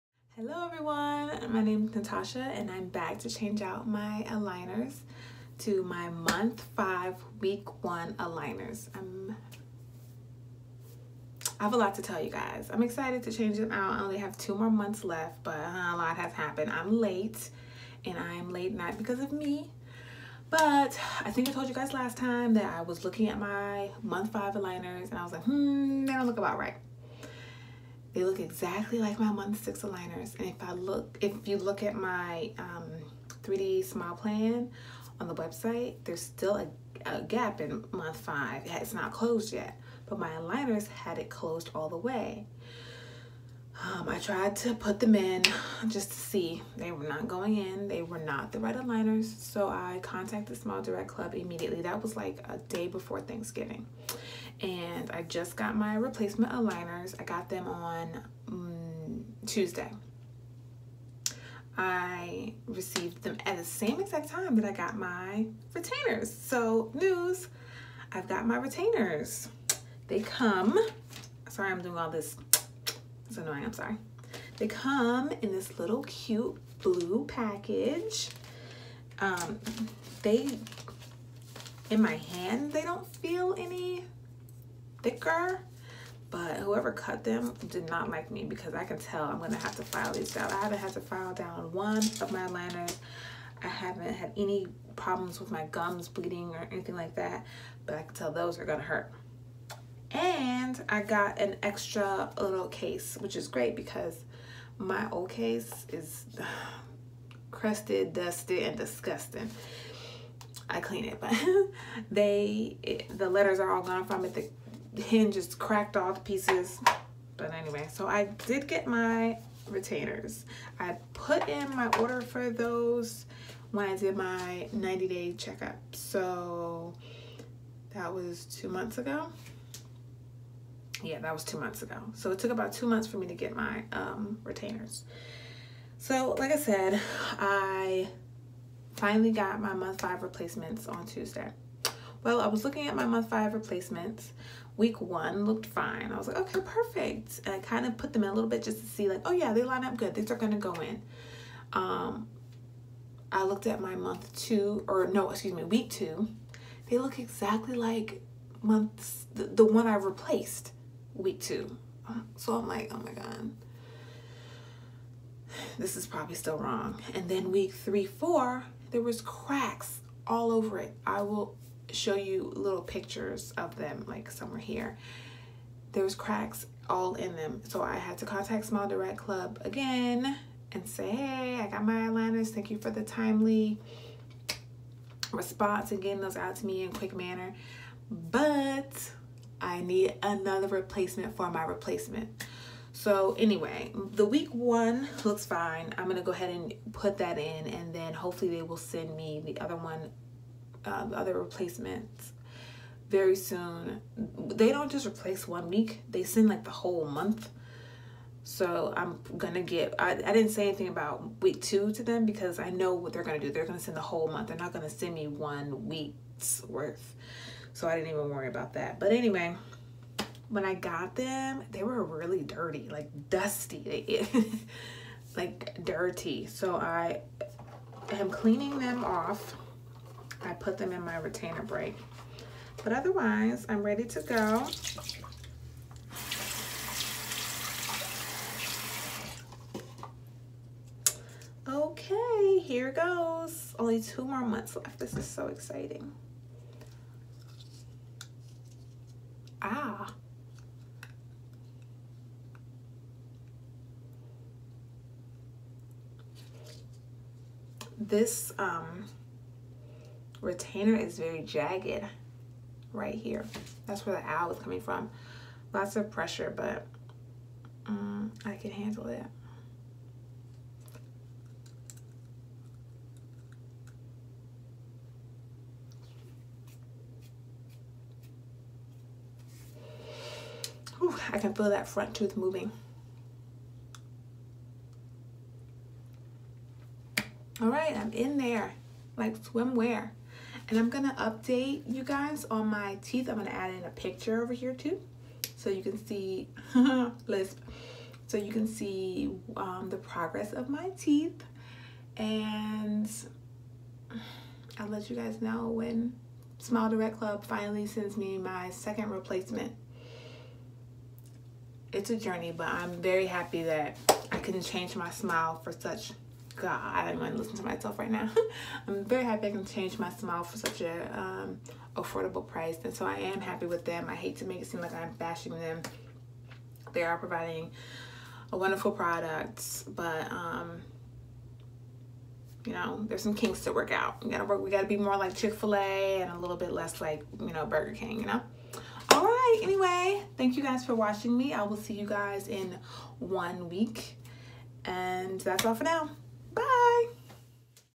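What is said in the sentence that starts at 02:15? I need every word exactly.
So like I said, I finally got my month five replacements on Tuesday.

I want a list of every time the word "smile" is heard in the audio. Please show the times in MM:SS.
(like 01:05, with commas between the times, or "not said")
00:33, 00:50, 02:58, 05:06, 05:15, 05:20.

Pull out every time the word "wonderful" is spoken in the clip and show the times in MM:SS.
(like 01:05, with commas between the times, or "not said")
05:28.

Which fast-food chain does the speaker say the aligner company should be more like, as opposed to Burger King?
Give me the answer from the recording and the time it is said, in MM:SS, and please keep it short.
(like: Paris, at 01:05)
Chick-fil-A, at 05:35.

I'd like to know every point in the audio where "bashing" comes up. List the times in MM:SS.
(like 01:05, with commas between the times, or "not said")
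05:25.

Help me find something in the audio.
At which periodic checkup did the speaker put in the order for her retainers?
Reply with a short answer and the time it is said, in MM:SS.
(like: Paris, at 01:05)
90 day checkup, at 02:04.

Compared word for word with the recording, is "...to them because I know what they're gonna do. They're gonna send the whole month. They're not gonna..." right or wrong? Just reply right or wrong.
right.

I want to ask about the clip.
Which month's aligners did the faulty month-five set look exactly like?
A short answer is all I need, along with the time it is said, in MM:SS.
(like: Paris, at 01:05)
Month 6, at 00:29.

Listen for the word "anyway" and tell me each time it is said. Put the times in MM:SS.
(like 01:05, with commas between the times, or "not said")
01:57, 03:13, 03:39, 05:39.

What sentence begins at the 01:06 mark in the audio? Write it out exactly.
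So news, I've got my retainers.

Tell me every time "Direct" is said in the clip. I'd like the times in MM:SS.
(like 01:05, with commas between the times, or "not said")
00:50, 02:58, 05:06.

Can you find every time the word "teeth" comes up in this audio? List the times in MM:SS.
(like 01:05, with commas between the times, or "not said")
04:53, 05:00.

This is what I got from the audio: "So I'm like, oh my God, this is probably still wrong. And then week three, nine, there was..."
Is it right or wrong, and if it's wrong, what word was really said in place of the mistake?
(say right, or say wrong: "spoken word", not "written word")
wrong: "four", not "nine".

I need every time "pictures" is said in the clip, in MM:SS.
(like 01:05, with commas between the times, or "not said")
02:52, 04:53.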